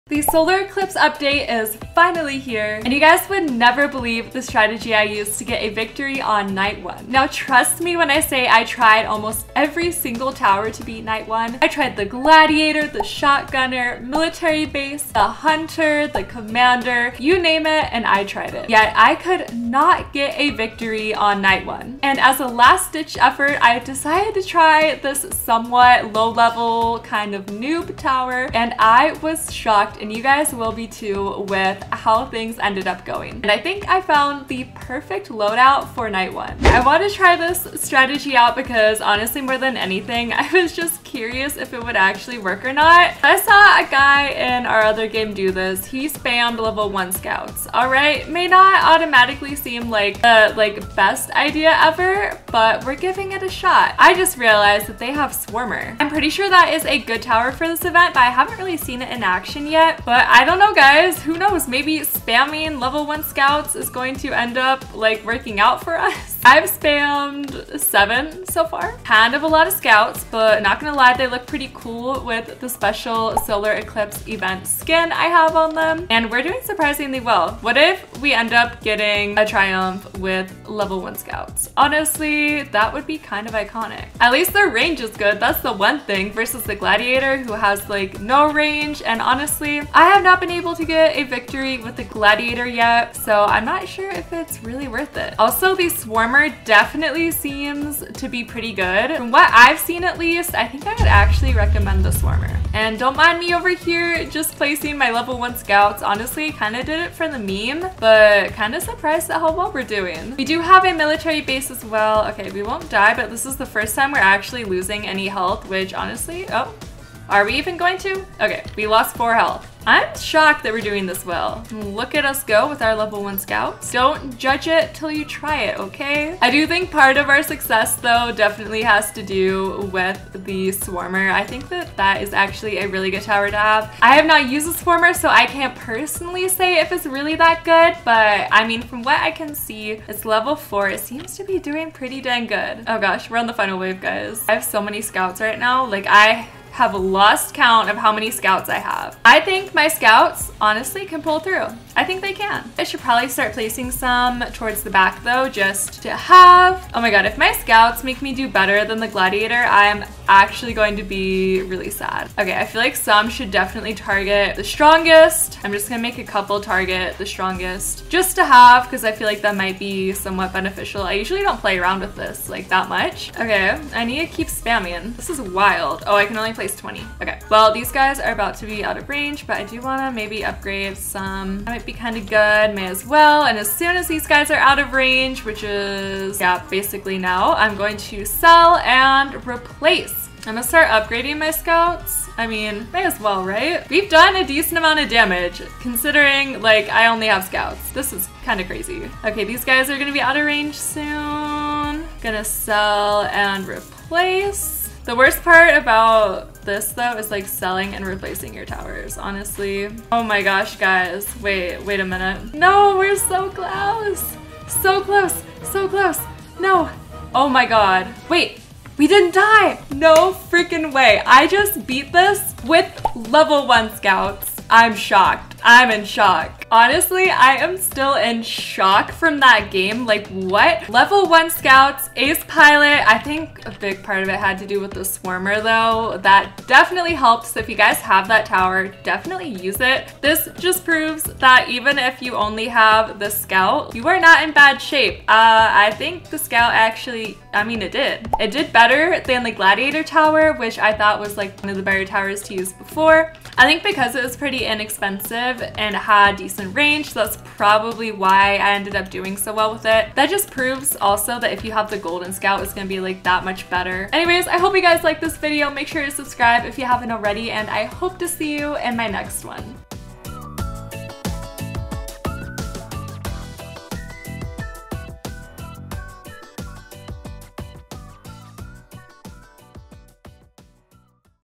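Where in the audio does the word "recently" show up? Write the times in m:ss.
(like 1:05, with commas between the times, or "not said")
not said.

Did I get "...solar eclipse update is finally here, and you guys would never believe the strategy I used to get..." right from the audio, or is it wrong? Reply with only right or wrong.
right.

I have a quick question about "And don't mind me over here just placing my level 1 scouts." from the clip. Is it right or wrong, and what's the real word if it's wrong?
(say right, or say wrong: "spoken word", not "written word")
right.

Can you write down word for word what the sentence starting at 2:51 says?
I usually don't play around with this like that much.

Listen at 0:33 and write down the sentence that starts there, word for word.
And I think I found the perfect loadout for night one.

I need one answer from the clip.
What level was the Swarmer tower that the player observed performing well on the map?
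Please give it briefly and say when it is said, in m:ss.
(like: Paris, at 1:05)
4, at 2:20.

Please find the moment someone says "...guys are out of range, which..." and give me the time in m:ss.
3:04.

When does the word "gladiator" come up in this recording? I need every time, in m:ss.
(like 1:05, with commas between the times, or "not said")
0:12, 1:26, 1:32, 2:39, 4:09.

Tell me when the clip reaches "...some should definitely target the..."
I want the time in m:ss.
2:42.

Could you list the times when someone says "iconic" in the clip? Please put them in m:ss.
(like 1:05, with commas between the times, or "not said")
1:23.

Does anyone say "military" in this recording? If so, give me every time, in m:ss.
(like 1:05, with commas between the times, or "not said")
0:14, 1:50.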